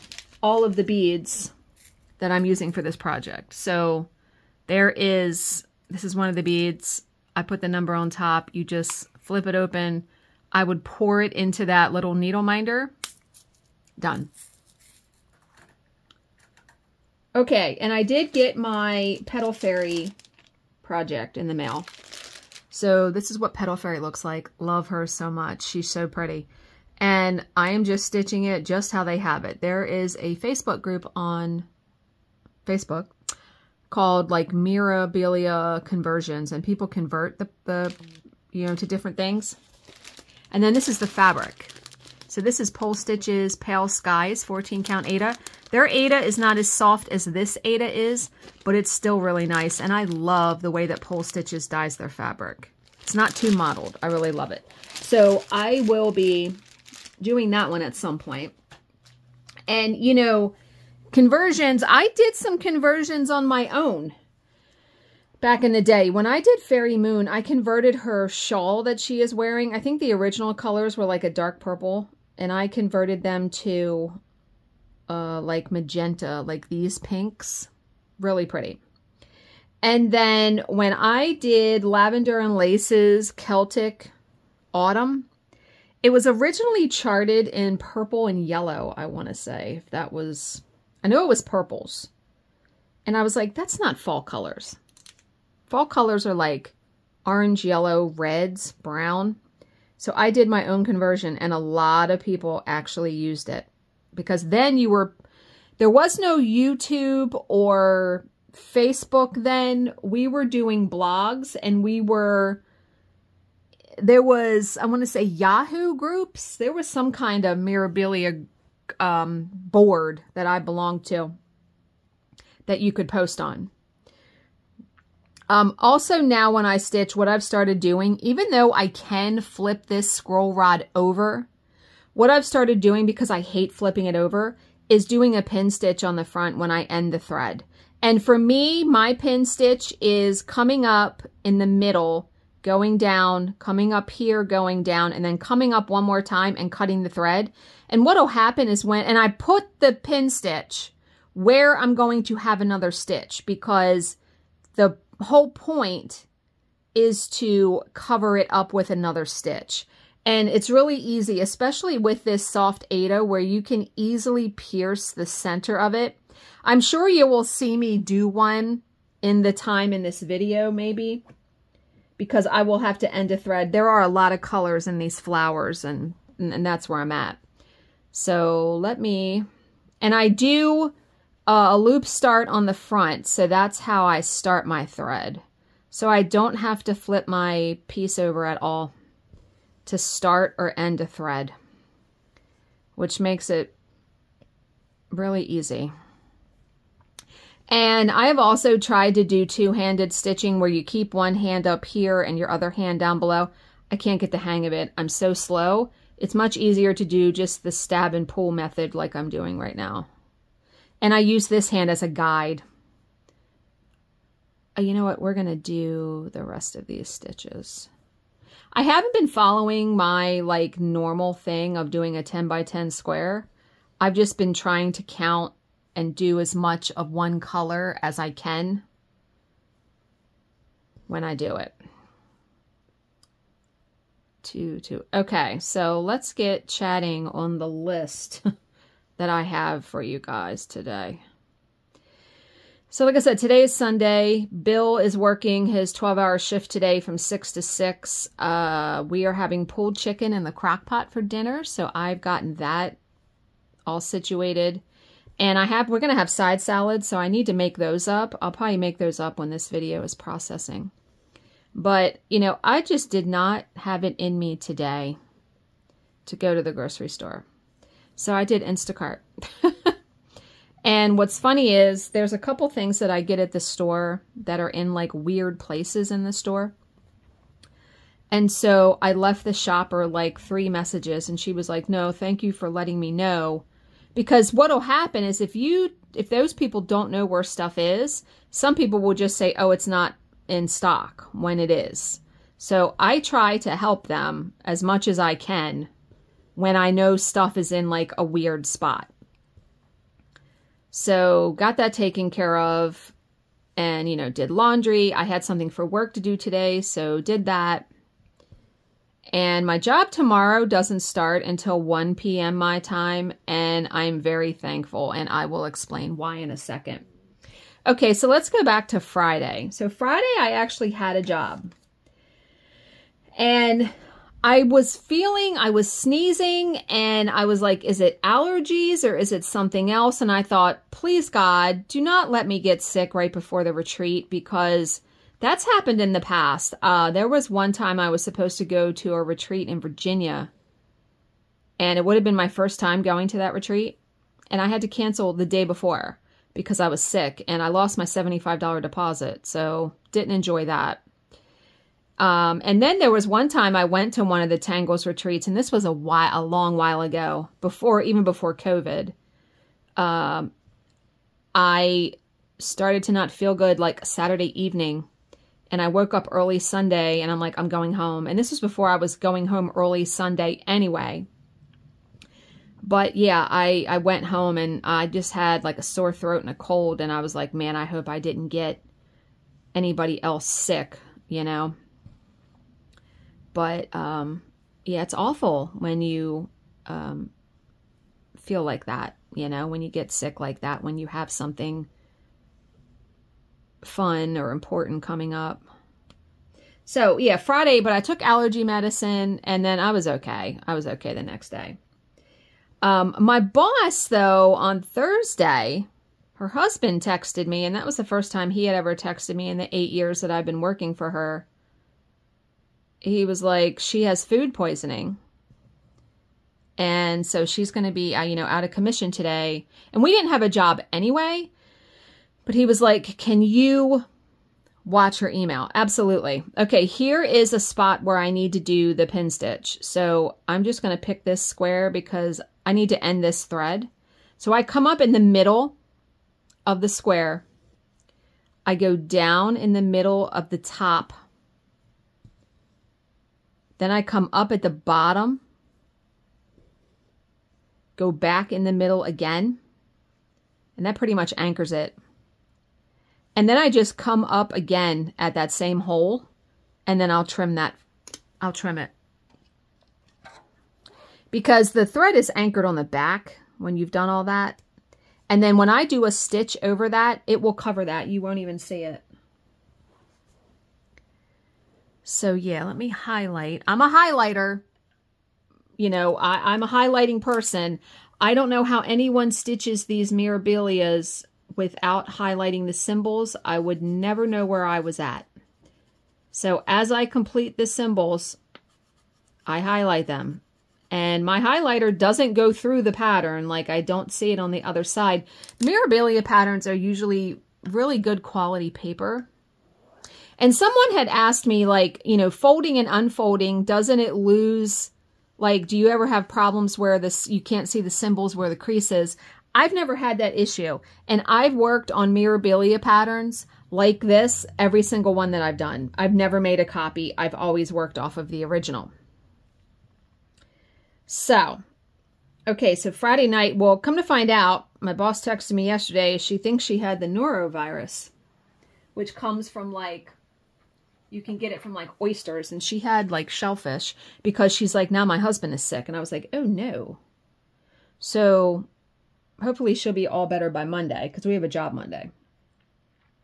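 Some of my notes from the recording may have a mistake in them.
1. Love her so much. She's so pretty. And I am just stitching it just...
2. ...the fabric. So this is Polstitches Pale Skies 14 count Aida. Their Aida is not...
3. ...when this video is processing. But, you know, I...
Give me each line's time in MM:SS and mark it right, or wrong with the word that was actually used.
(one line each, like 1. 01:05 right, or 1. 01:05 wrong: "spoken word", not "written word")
1. 00:24 right
2. 00:40 right
3. 04:19 right.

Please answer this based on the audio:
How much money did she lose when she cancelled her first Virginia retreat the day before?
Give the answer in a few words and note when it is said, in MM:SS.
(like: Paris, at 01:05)
$75, at 05:48.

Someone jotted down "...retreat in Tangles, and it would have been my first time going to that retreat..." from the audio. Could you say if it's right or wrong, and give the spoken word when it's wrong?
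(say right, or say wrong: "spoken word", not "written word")
wrong: "Virginia", not "Tangles".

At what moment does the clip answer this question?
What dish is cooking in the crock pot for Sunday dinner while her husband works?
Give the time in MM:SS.
04:09.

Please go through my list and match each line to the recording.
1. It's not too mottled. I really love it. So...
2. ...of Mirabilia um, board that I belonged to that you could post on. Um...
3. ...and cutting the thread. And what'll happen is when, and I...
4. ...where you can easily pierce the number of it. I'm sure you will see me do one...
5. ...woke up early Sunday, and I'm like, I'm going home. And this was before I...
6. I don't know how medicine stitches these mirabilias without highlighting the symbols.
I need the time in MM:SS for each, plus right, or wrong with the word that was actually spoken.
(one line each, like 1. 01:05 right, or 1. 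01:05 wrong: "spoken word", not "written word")
1. 00:53 right
2. 01:57 right
3. 02:26 right
4. 02:43 wrong: "center", not "number"
5. 06:05 right
6. 07:58 wrong: "anyone", not "medicine".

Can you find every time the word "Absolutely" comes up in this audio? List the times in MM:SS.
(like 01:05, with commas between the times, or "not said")
07:05.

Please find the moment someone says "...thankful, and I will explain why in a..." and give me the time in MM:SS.
05:14.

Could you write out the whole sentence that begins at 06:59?
And we didn't have a job anyway.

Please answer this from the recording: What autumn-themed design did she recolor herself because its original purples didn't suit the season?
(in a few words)
Celtic Autumn.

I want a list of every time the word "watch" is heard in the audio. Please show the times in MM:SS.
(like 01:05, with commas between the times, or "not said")
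07:04.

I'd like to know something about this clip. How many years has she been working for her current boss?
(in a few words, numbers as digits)
8.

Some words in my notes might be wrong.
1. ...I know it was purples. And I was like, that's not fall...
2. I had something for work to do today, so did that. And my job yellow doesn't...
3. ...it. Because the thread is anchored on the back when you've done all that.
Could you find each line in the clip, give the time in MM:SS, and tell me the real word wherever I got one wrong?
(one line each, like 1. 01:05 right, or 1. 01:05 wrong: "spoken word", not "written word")
1. 01:31 right
2. 05:05 wrong: "tomorrow", not "yellow"
3. 07:38 right.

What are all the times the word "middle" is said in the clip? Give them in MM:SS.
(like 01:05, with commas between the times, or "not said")
02:21, 07:15, 07:19, 07:28.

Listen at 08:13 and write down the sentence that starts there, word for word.
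Like I don't see it on the other side.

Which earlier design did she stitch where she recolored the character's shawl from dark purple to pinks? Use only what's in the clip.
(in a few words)
Fairy Moon.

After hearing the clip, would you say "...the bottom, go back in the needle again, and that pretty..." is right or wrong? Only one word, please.
wrong.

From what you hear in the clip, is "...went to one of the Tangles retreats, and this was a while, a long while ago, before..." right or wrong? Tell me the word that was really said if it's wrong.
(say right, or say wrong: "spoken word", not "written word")
right.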